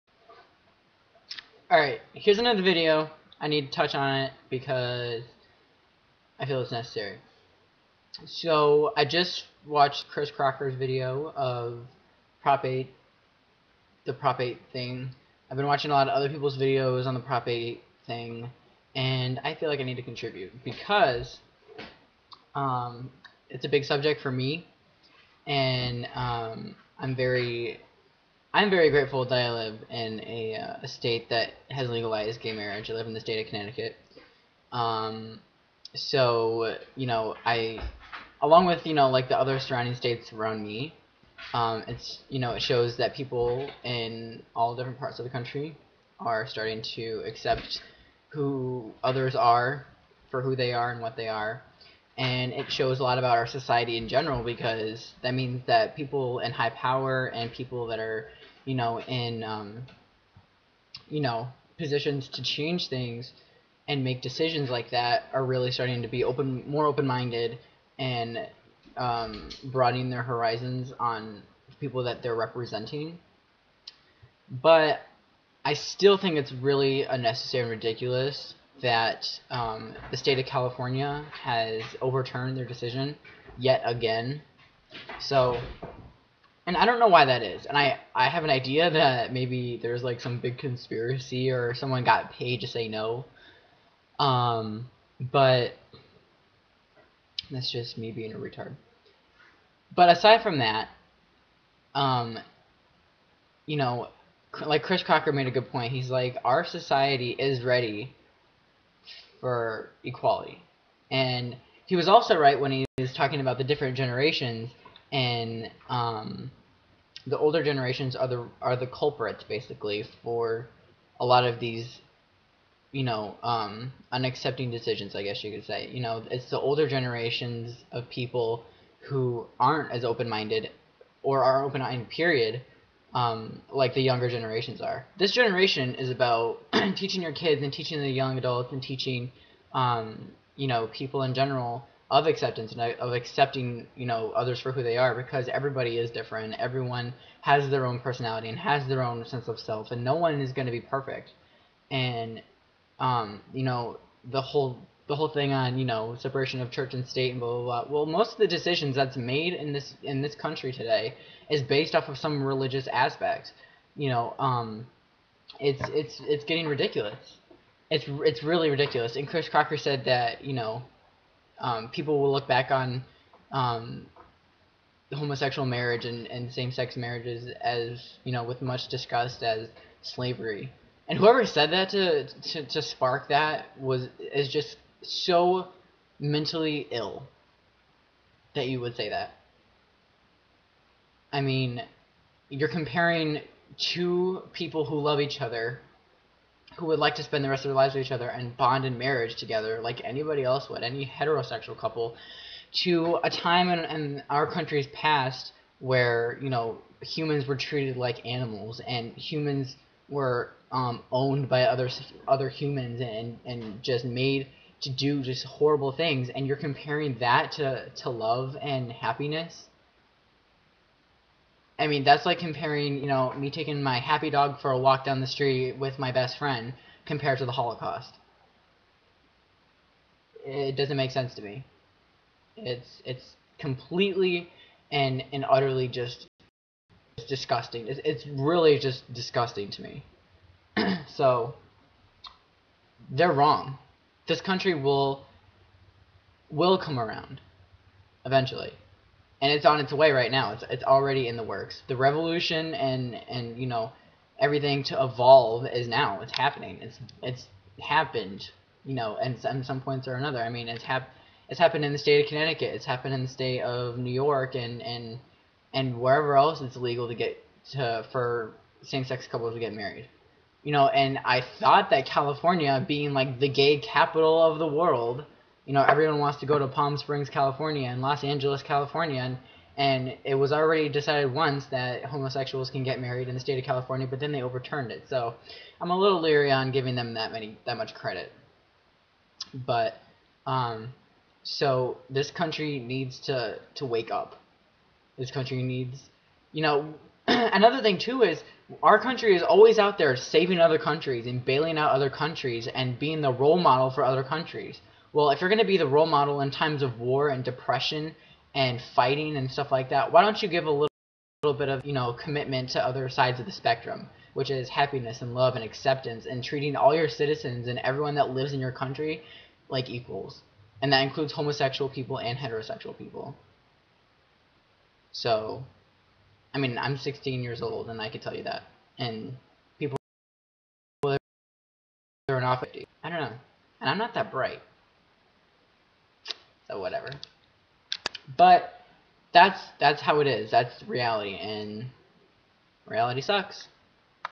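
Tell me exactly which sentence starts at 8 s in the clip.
So, I just watched Chris Crocker's video of Prop 8, the Prop 8 thing.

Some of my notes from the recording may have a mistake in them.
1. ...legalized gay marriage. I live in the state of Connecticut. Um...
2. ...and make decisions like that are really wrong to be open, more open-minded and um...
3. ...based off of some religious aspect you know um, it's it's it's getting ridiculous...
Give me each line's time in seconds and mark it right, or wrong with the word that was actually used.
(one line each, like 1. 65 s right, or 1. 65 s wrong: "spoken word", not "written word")
1. 31 s right
2. 63 s wrong: "starting", not "wrong"
3. 161 s right.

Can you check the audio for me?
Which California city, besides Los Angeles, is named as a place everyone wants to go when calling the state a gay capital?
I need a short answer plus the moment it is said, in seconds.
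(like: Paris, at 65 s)
Palm Springs, at 276 s.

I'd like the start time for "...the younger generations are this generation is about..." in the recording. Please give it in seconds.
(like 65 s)
133 s.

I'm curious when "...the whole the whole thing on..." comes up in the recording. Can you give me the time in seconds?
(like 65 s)
154 s.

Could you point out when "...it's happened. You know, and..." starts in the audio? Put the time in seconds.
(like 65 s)
257 s.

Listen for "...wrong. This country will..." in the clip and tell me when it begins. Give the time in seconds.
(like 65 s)
243 s.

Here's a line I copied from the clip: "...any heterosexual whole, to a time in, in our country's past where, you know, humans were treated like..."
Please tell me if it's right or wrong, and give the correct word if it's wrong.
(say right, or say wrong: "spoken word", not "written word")
wrong: "couple", not "whole".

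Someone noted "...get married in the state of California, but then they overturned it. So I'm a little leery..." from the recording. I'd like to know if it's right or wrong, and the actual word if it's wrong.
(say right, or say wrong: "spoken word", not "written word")
right.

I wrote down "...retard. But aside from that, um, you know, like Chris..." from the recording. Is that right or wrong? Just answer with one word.
right.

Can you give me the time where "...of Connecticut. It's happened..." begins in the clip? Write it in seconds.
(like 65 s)
262 s.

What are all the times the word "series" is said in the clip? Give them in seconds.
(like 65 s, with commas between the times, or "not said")
not said.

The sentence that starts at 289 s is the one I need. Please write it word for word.
But um, so this country needs to to wake up.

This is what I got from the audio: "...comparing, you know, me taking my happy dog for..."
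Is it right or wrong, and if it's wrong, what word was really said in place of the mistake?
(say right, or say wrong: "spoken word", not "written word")
right.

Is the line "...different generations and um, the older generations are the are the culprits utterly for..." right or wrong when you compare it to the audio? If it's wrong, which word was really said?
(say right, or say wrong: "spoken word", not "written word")
wrong: "basically", not "utterly".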